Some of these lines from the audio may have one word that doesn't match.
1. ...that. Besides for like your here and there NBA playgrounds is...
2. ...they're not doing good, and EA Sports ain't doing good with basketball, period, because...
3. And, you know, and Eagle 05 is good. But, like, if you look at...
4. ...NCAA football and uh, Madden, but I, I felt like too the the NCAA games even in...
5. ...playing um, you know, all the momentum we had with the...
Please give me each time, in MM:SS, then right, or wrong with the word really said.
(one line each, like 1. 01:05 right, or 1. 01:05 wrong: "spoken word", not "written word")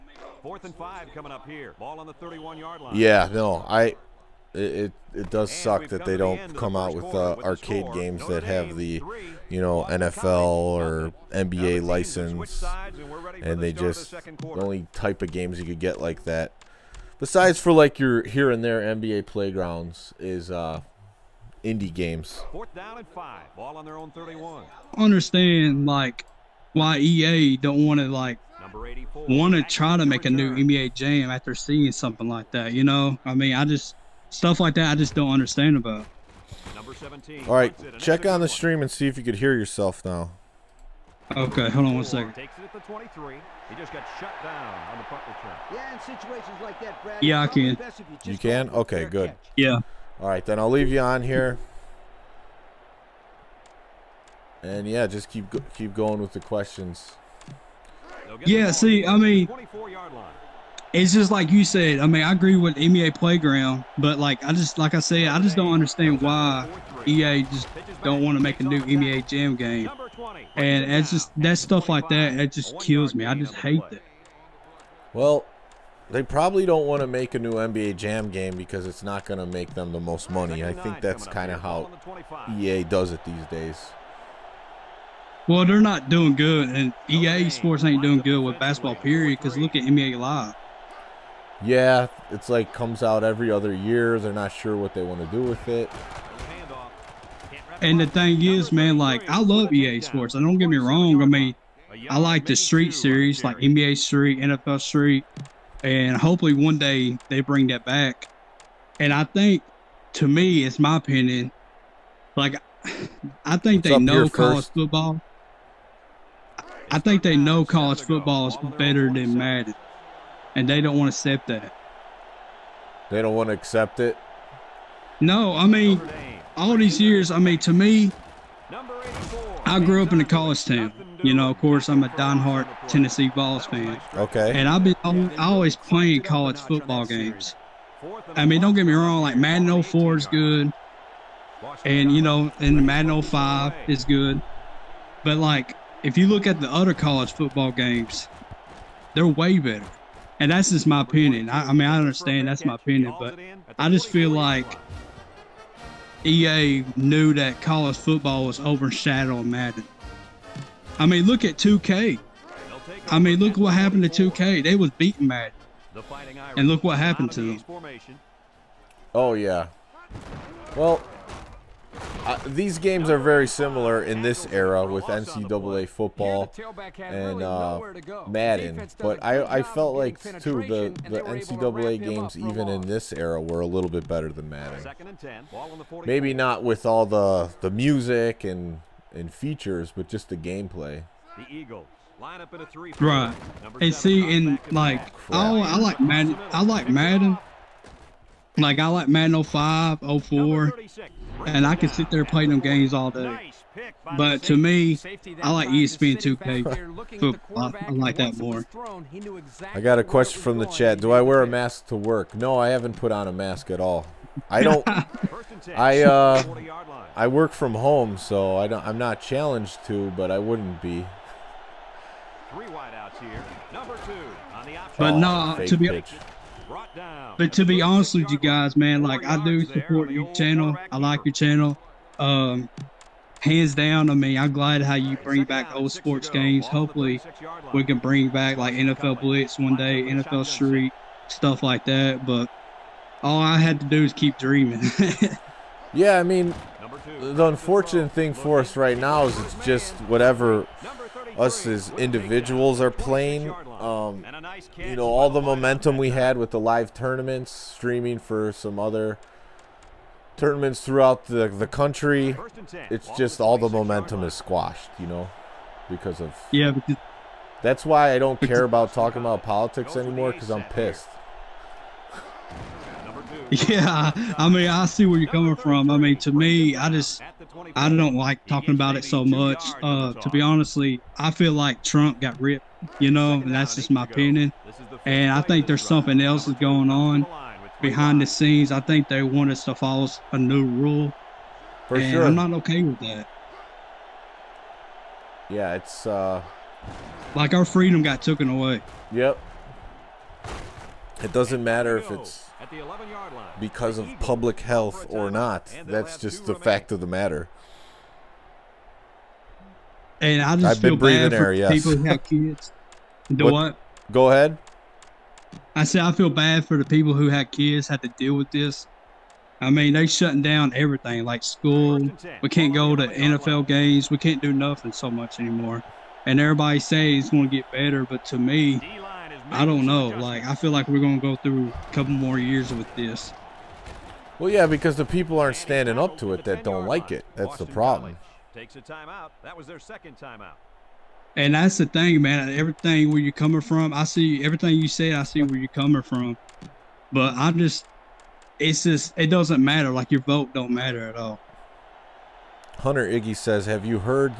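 1. 00:16 right
2. 01:25 right
3. 02:21 wrong: "Madden", not "Eagle"
4. 02:55 right
5. 04:12 right.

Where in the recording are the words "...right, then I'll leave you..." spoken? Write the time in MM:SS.
00:50.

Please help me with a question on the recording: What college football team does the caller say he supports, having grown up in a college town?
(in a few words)
Tennessee Vols.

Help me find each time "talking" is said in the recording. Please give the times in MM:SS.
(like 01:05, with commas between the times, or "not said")
04:28, 04:38.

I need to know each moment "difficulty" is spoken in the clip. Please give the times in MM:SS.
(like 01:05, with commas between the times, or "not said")
not said.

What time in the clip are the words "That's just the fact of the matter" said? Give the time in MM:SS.
05:05.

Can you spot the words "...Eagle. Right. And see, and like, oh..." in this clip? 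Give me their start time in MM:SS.
03:11.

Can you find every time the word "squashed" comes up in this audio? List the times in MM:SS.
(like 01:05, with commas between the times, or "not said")
04:24.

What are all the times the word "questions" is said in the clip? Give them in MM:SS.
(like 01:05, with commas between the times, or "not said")
00:56, 03:30.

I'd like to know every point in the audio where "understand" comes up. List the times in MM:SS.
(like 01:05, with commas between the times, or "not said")
00:24, 00:35, 01:05, 02:31.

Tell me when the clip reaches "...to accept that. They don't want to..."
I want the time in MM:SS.
02:01.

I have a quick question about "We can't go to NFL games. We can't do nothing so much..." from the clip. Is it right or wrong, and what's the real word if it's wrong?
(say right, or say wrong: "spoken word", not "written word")
right.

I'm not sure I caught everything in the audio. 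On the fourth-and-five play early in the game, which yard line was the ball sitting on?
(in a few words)
31.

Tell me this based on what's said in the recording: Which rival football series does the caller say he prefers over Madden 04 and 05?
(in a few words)
ESPN 2K.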